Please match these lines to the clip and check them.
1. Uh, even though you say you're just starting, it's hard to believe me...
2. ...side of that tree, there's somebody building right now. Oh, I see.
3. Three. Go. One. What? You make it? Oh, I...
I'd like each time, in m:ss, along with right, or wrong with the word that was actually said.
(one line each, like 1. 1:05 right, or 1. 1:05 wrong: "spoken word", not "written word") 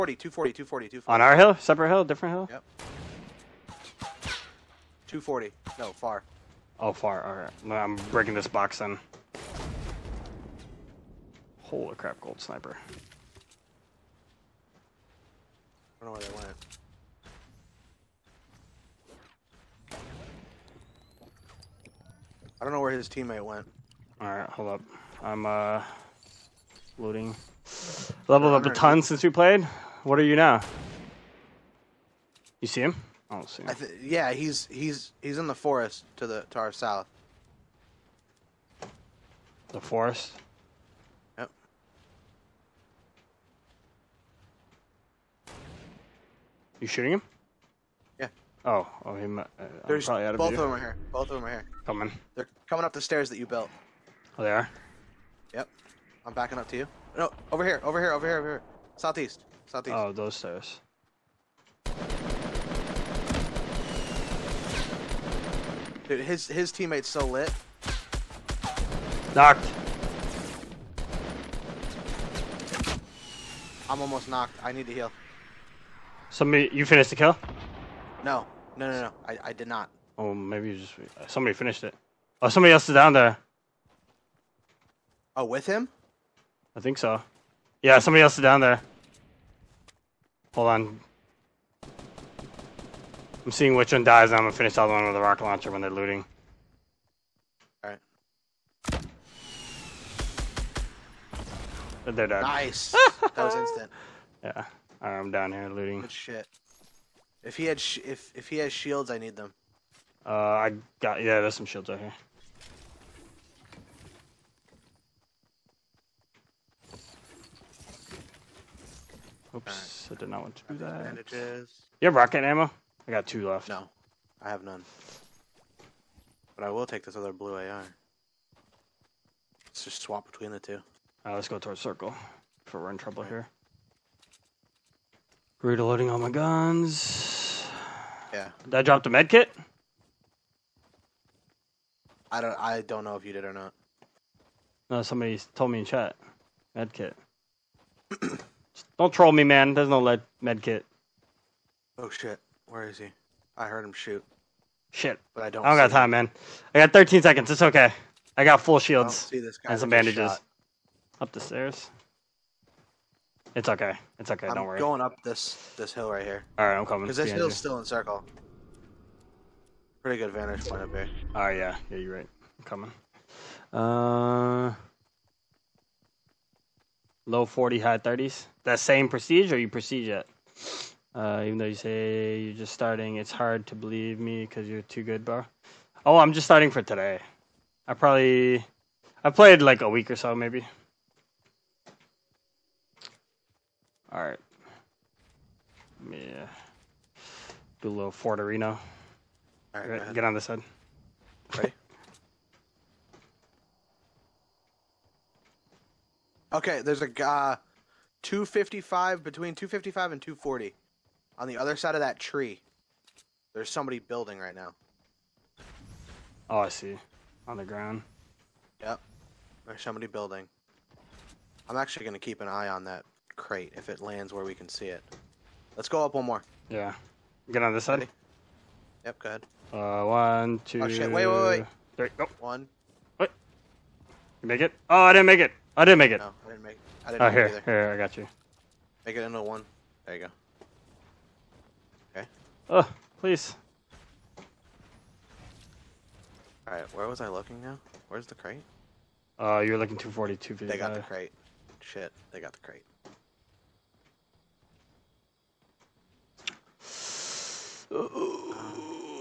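1. 3:01 right
2. 3:31 right
3. 3:51 right.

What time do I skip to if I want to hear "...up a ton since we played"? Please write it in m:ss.
0:28.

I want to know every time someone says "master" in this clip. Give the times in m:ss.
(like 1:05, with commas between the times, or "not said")
not said.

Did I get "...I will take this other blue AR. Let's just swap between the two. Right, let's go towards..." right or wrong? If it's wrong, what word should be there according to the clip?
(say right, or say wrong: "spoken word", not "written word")
right.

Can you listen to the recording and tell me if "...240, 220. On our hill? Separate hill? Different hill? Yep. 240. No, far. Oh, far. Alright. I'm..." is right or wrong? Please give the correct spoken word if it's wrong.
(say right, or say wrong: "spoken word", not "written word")
wrong: "240", not "220".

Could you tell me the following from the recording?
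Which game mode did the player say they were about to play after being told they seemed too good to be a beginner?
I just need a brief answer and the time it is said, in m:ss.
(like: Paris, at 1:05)
Fort Arena, at 3:18.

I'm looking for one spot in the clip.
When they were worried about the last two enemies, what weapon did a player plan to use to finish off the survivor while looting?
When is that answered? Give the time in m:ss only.
1:35.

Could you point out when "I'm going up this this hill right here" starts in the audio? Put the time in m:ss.
2:44.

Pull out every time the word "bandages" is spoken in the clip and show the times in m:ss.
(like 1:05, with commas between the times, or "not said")
2:01, 2:39.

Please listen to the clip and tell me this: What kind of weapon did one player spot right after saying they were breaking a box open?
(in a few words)
Gold sniper.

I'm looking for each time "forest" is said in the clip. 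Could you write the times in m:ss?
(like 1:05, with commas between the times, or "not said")
0:35, 0:39.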